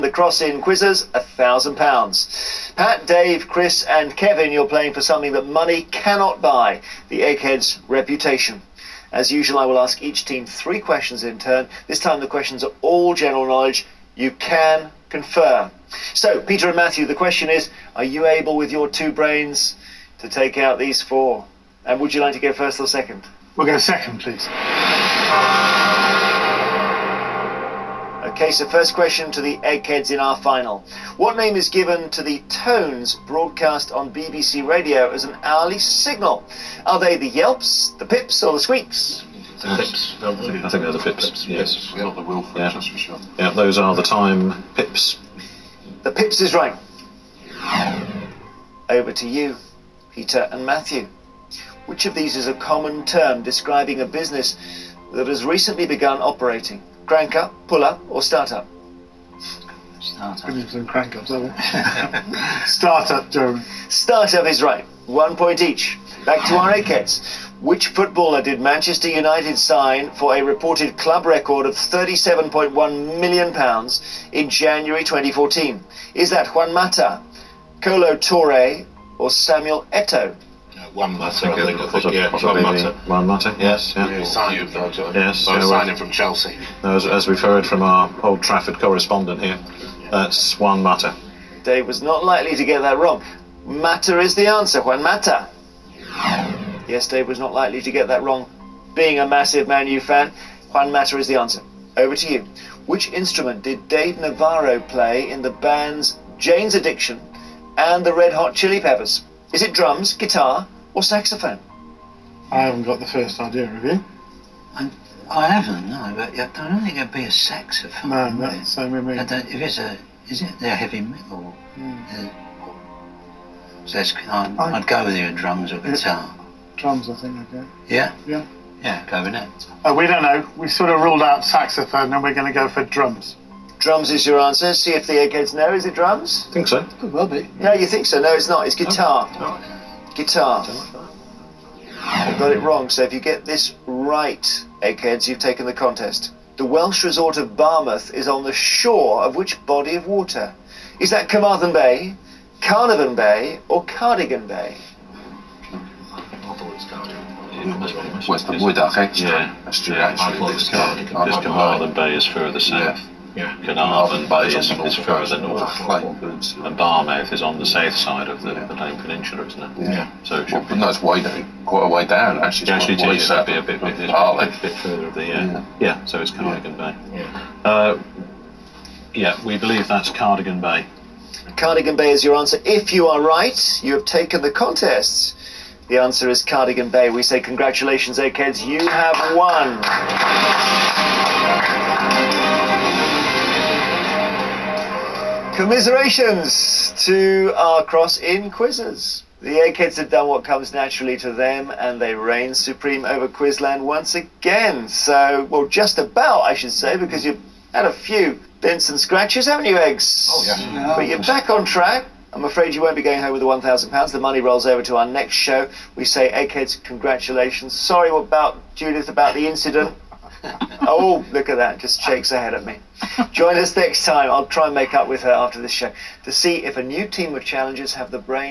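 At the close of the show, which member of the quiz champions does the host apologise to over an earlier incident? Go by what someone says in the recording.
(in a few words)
Judith.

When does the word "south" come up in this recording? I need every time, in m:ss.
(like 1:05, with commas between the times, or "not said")
2:42, 2:47.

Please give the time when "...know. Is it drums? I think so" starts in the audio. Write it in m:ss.
2:15.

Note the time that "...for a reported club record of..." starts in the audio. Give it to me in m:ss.
1:10.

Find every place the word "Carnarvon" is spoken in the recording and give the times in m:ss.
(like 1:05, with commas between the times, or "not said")
2:32, 2:43.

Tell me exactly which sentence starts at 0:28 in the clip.
Okay, so first question to the eggheads in our final.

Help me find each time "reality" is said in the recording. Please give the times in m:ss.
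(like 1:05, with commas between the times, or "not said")
not said.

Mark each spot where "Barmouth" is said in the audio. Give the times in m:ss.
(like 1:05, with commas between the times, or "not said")
2:27, 2:46.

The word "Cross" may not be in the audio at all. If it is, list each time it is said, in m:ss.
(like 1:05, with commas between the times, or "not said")
0:00, 3:17.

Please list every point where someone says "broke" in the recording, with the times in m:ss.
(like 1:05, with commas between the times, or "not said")
not said.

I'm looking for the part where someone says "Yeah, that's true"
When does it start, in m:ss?
2:39.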